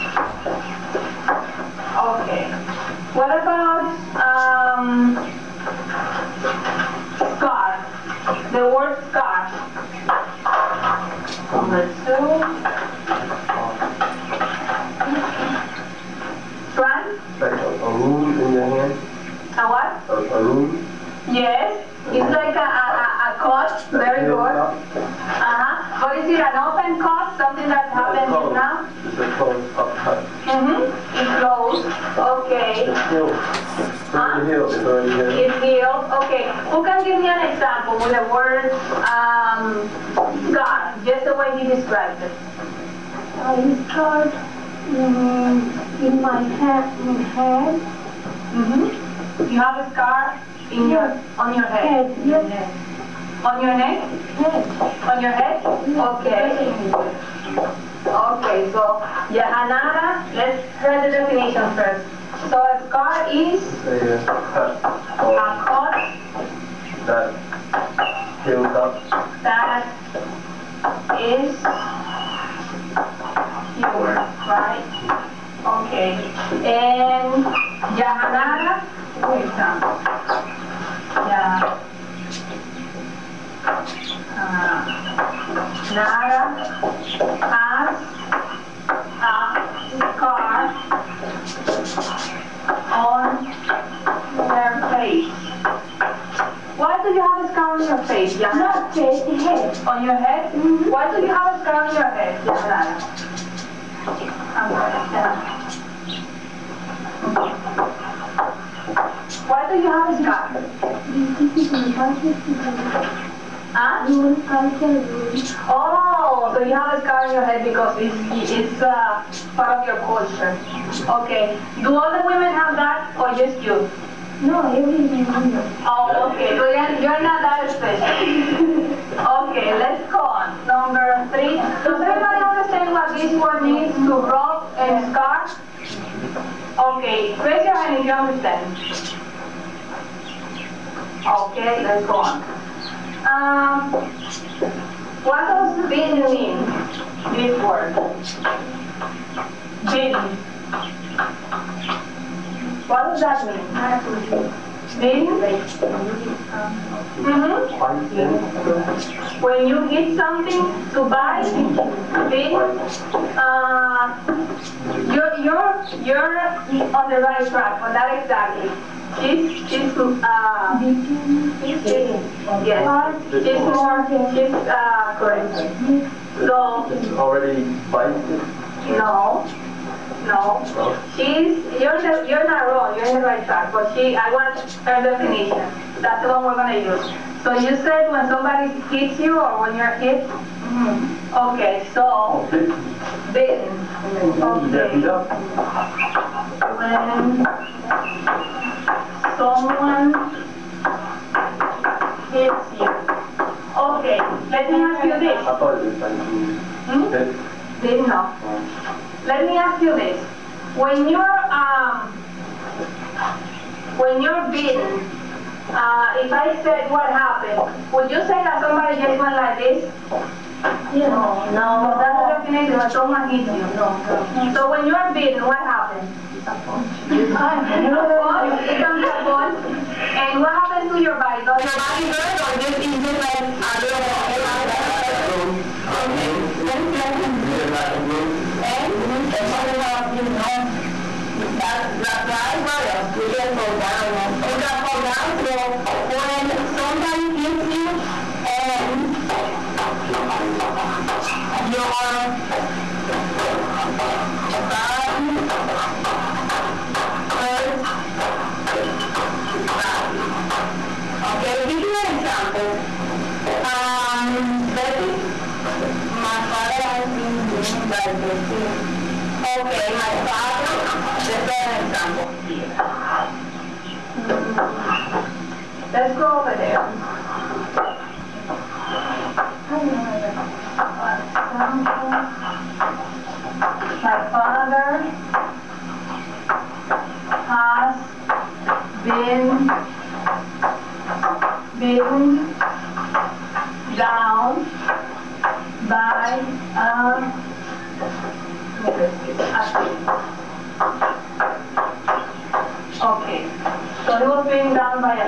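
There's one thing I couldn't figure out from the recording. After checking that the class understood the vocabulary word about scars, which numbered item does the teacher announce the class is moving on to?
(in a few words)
Number 3.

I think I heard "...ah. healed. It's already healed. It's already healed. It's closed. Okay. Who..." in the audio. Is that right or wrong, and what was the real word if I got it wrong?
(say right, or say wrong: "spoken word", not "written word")
wrong: "healed", not "closed".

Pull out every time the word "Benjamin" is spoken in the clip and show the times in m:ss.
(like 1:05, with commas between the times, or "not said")
2:25.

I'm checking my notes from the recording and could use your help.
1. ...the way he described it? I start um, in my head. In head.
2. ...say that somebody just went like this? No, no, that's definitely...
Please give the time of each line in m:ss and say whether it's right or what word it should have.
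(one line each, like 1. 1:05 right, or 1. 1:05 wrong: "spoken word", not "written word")
1. 0:41 right
2. 3:38 right.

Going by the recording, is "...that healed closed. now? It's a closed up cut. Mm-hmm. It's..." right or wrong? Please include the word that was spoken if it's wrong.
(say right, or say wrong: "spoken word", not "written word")
wrong: "happened", not "healed".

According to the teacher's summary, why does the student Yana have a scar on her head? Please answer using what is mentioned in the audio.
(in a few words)
part of your culture.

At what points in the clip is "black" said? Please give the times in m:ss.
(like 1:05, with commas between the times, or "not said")
3:57.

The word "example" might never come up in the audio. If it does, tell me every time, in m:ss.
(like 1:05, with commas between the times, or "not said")
0:37, 1:19, 4:22, 4:31.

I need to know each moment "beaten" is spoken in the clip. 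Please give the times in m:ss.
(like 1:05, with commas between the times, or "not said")
3:34, 3:45, 4:51.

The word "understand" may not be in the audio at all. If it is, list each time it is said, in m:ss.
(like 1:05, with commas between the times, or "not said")
2:12, 2:18.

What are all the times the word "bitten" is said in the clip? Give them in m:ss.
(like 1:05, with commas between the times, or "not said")
3:13, 4:27.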